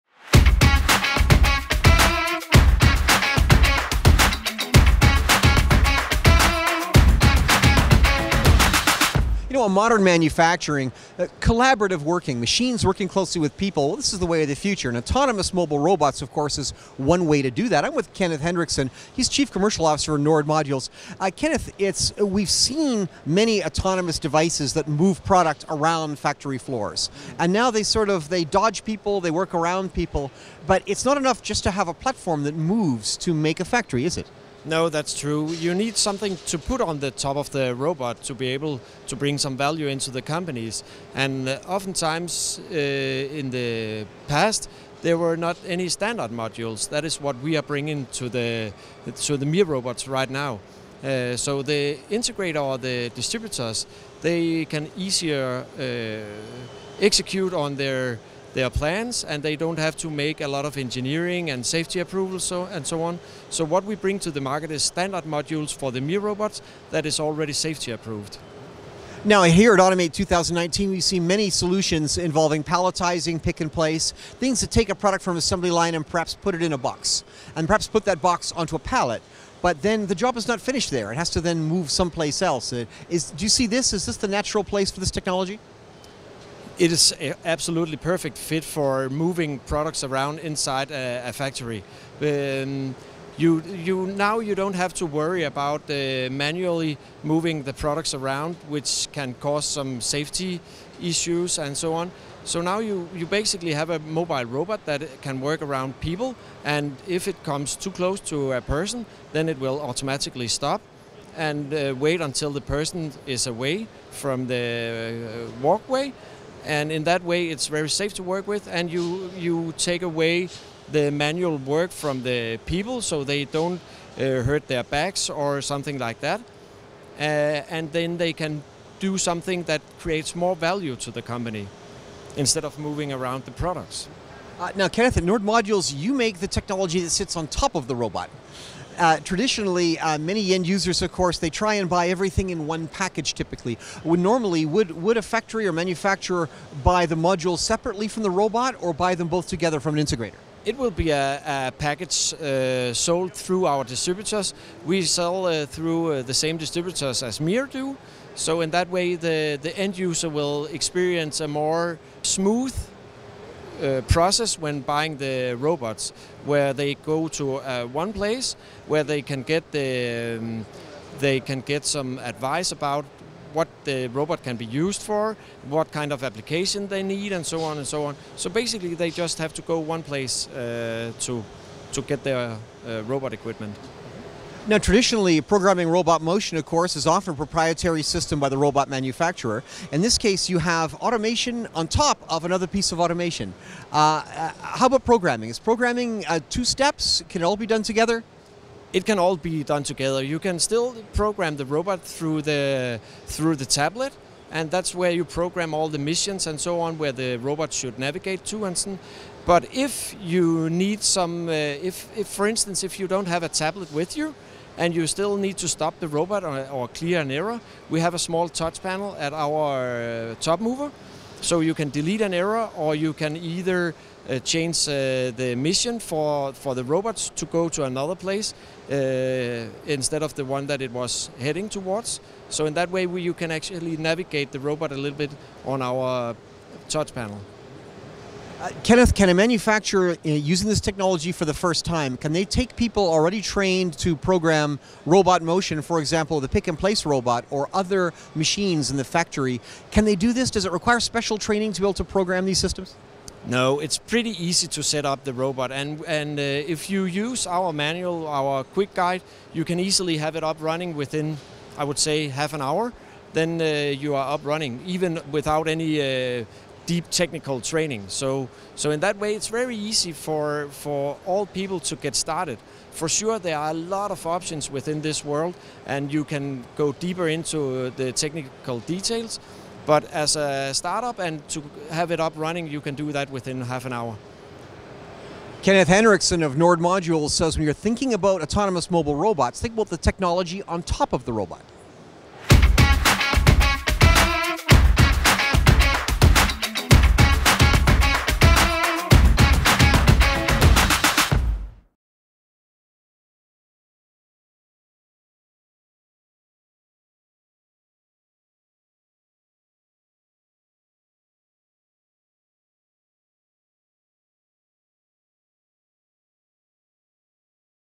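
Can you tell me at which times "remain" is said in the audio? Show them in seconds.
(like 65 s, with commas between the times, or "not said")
not said.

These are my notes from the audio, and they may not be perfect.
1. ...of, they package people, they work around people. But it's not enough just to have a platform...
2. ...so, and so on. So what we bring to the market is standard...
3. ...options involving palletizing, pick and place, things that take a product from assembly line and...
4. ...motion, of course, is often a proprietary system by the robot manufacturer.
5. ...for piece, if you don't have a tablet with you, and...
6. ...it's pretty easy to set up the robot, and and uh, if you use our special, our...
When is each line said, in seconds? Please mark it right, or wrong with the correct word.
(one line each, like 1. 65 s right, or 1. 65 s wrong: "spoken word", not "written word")
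1. 28 s wrong: "dodge", not "package"
2. 62 s right
3. 71 s wrong: "solutions", not "options"
4. 186 s right
5. 212 s wrong: "instance", not "piece"
6. 253 s wrong: "manual", not "special".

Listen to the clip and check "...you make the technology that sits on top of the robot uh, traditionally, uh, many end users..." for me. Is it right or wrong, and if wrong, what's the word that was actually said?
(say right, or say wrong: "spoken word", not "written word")
right.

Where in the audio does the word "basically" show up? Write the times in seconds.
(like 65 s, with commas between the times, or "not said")
103 s, 178 s.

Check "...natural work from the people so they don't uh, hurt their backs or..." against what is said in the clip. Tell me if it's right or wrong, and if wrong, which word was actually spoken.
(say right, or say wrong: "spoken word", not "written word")
wrong: "manual", not "natural".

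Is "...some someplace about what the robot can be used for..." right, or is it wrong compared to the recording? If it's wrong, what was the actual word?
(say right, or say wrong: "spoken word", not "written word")
wrong: "advice", not "someplace".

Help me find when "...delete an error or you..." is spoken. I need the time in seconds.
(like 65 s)
221 s.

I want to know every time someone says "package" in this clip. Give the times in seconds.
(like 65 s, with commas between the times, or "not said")
142 s, 151 s.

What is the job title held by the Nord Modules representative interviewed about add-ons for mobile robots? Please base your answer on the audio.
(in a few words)
Chief Commercial Officer.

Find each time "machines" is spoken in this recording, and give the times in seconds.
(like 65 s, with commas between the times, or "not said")
12 s, 248 s.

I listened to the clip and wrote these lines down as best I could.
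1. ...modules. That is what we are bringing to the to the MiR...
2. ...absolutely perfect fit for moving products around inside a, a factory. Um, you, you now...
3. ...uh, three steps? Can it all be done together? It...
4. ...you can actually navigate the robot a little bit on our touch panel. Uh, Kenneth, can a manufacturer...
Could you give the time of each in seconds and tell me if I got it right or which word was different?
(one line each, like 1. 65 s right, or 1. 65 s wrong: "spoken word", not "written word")
1. 46 s right
2. 87 s right
3. 196 s wrong: "two", not "three"
4. 233 s right.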